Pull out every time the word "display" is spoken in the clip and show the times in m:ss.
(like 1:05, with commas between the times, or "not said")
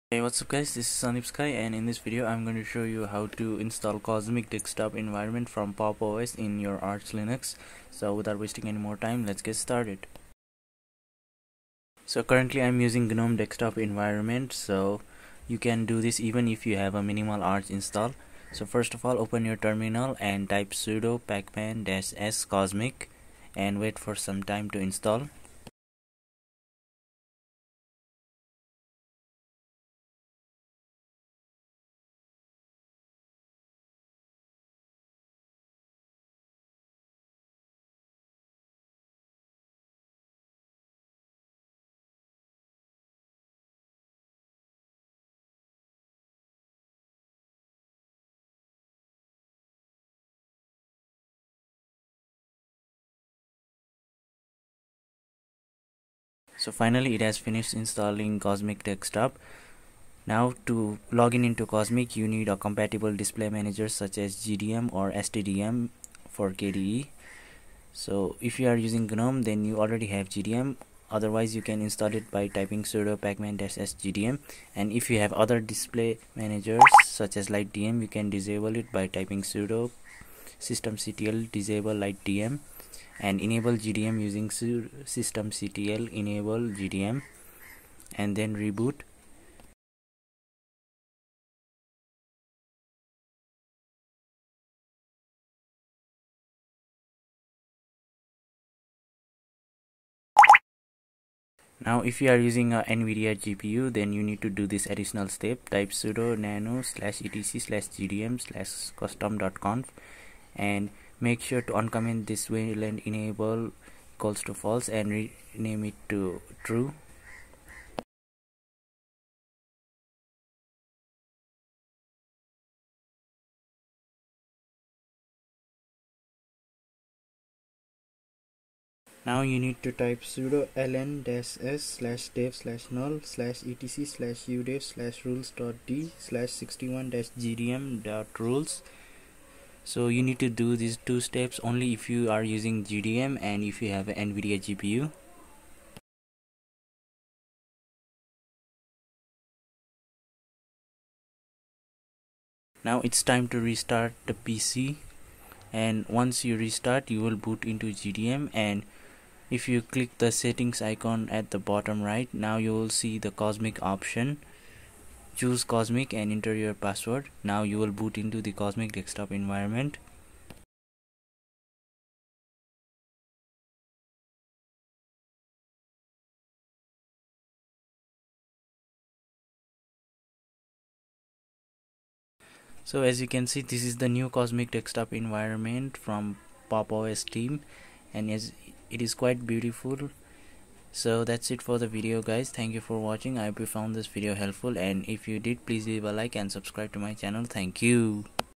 1:03, 1:15.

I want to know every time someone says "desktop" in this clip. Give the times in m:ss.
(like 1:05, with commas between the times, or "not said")
0:04, 0:13, 0:58, 2:48, 3:04.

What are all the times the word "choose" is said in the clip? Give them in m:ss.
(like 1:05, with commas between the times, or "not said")
2:45.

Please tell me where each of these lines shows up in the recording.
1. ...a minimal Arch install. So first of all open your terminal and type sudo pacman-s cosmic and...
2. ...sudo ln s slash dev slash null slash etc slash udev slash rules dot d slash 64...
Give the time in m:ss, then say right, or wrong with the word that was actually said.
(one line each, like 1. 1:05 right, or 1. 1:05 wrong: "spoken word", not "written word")
1. 0:16 right
2. 2:10 wrong: "61", not "64".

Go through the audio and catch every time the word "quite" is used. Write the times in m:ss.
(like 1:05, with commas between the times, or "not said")
3:09.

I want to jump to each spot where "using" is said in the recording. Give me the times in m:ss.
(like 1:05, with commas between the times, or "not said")
0:12, 1:08, 1:24, 1:42, 2:22.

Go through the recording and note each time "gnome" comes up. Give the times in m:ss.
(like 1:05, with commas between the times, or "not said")
0:13, 1:09.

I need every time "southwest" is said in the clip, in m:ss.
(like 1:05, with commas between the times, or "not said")
not said.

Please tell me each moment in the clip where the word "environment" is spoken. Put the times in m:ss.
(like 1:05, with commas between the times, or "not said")
0:05, 0:13, 2:49, 3:05.